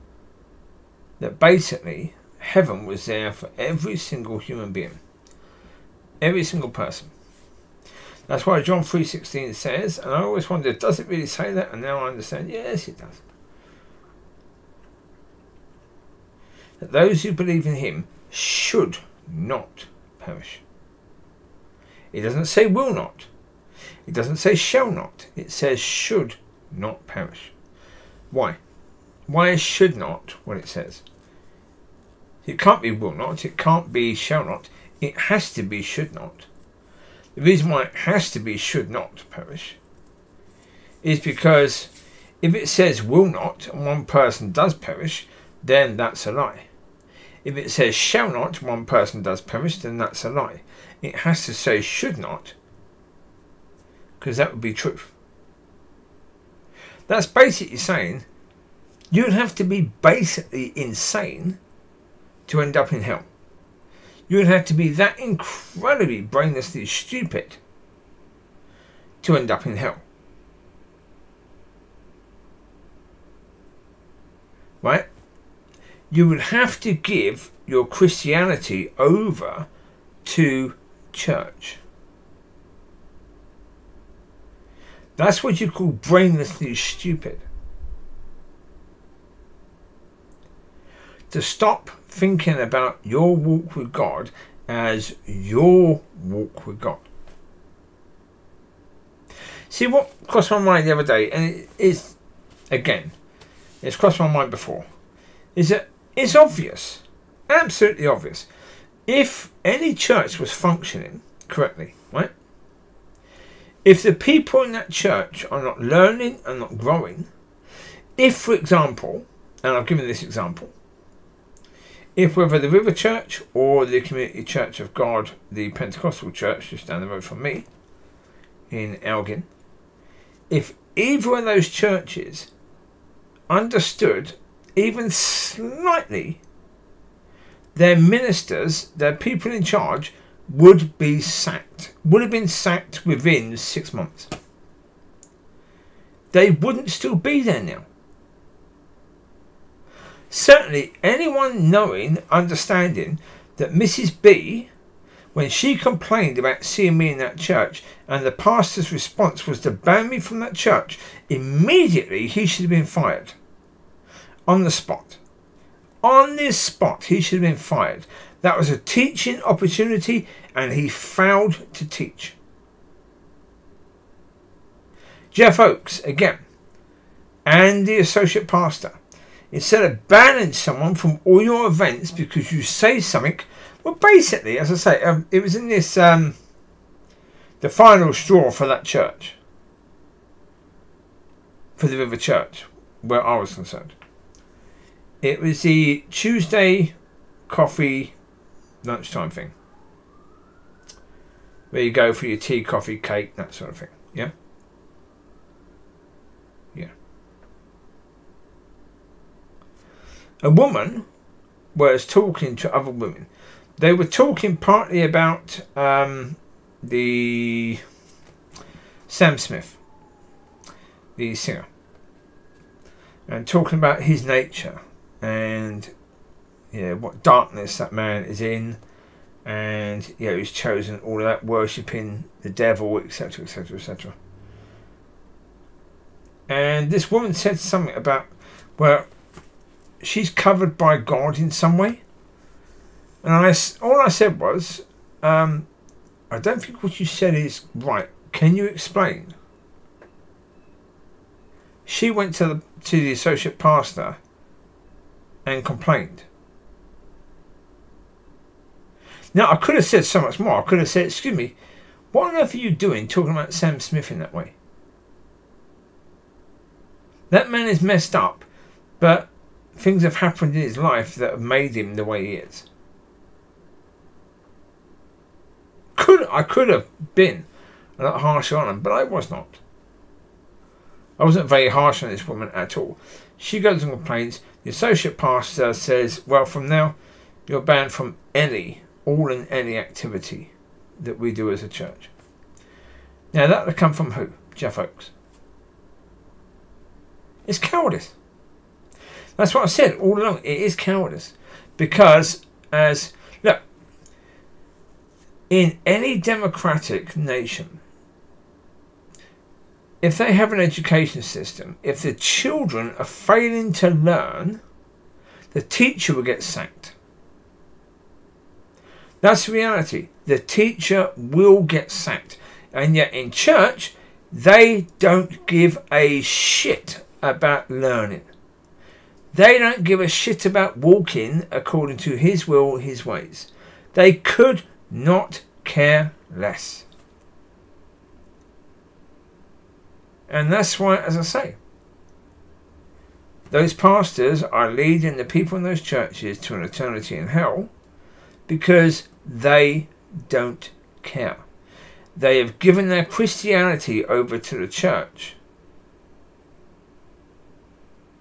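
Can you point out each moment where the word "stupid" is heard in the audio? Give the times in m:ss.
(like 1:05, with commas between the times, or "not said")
1:06, 1:26.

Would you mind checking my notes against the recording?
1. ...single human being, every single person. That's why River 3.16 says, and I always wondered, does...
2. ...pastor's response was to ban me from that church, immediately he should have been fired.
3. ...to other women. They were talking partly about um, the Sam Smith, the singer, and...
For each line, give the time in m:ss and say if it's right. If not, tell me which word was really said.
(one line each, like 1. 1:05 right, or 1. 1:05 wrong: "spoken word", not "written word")
1. 0:03 wrong: "John", not "River"
2. 2:38 right
3. 3:32 right.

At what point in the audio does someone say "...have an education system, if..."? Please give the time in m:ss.
5:10.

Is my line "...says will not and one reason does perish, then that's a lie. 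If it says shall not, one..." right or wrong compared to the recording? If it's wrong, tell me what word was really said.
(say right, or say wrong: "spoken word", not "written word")
wrong: "person", not "reason".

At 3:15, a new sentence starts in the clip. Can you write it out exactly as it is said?
It was the Tuesday coffee lunchtime thing.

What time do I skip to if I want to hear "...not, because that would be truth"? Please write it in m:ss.
0:52.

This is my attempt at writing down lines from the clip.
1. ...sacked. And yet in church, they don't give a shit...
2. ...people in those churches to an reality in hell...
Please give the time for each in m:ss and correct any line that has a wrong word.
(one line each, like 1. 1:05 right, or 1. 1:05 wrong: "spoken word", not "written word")
1. 5:21 right
2. 5:45 wrong: "eternity", not "reality".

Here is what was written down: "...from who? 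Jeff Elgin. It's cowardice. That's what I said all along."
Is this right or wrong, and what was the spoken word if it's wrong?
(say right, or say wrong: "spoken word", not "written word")
wrong: "Oakes", not "Elgin".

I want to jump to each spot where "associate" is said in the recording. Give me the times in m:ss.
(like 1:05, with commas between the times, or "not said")
2:57, 4:13, 4:44.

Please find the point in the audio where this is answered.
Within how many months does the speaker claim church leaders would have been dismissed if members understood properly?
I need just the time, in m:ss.
2:23.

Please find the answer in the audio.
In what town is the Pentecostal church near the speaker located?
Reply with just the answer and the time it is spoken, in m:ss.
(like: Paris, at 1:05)
Elgin, at 2:09.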